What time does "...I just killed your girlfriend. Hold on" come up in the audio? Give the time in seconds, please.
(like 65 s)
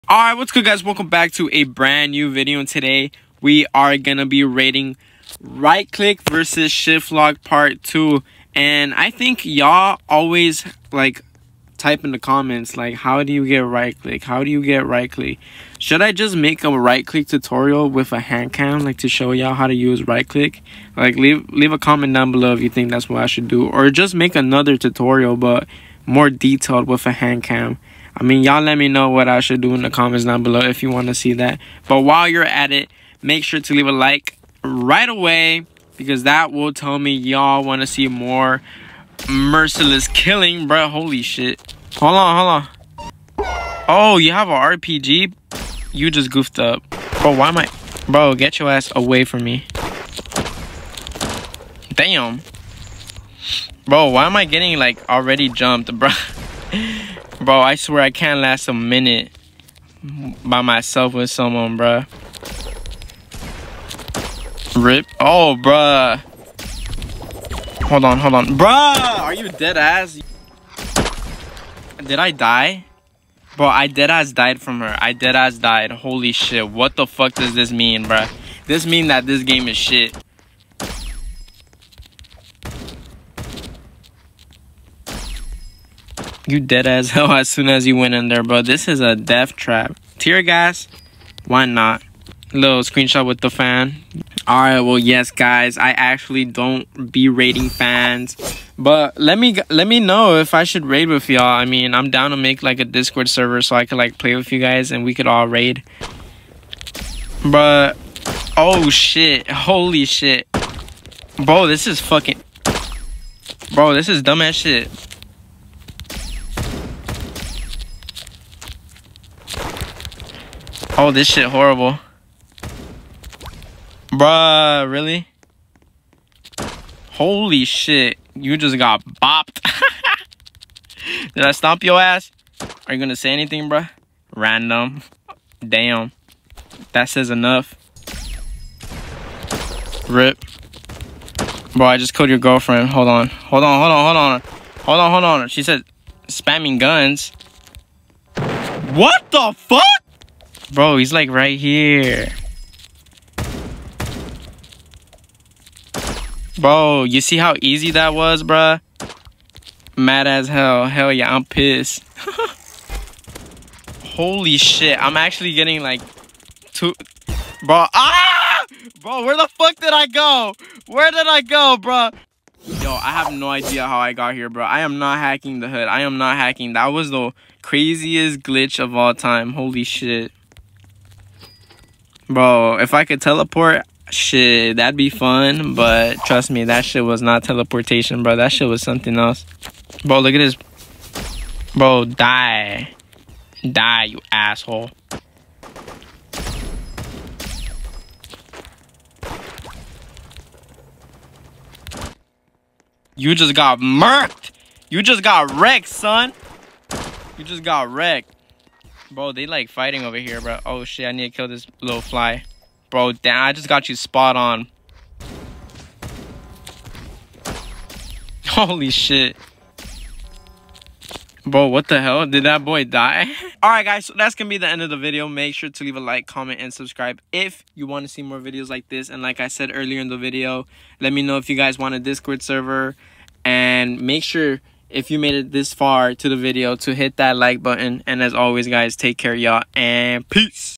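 141 s.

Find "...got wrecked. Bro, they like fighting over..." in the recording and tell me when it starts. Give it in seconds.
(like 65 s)
207 s.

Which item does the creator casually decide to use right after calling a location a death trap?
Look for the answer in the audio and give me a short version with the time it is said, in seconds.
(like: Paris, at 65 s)
Tear gas, at 90 s.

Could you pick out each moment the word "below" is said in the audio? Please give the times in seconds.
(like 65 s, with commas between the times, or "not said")
22 s, 30 s.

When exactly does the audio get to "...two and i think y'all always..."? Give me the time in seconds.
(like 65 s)
7 s.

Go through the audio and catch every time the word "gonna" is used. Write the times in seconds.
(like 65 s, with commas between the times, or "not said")
3 s, 132 s, 224 s.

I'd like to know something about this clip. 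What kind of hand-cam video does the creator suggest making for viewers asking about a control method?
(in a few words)
Right click tutorial.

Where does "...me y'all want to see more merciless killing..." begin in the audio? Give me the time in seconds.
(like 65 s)
36 s.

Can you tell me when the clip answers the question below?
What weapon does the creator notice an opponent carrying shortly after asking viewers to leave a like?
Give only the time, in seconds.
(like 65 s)
44 s.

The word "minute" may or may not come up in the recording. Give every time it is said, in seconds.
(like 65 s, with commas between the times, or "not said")
58 s.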